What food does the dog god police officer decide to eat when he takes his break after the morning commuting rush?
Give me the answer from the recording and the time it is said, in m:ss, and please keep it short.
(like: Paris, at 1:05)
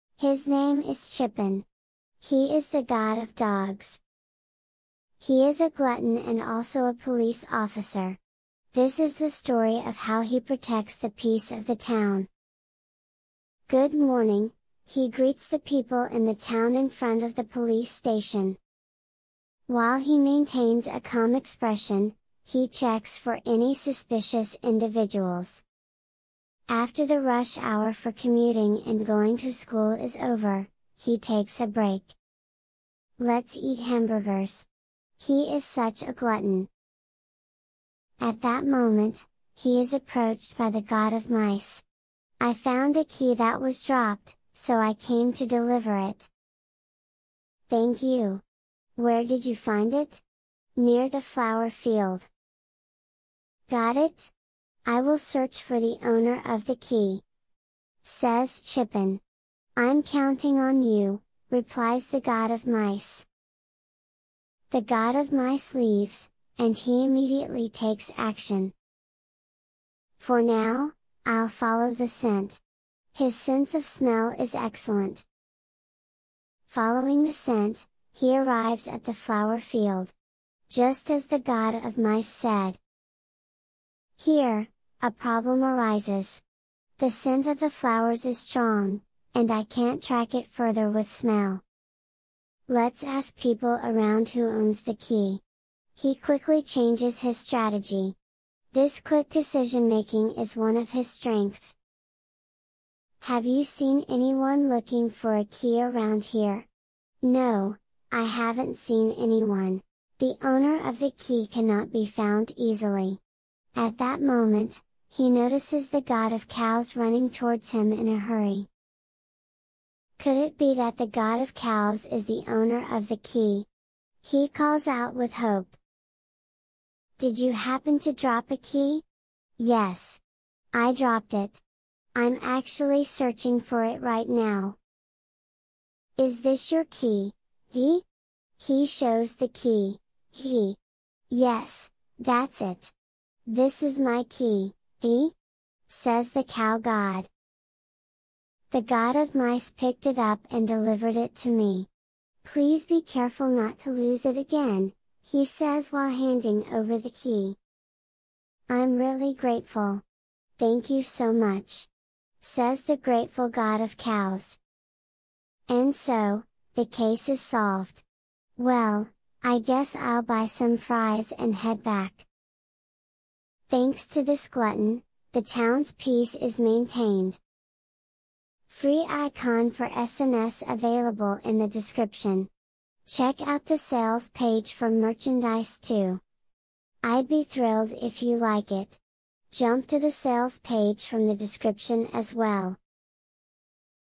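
Hamburgers, at 0:33.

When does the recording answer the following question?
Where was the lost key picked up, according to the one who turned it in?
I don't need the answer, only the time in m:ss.
0:50.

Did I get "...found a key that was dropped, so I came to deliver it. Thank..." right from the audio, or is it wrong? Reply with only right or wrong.
right.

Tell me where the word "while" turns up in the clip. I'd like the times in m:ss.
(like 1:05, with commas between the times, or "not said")
0:19, 2:35.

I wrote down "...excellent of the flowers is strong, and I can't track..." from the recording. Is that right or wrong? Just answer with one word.
wrong.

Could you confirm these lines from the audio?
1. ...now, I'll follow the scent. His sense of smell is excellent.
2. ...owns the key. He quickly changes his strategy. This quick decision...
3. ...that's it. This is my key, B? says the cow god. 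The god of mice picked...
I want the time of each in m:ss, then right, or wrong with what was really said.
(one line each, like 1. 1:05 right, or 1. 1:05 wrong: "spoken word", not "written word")
1. 1:10 right
2. 1:34 right
3. 2:22 right.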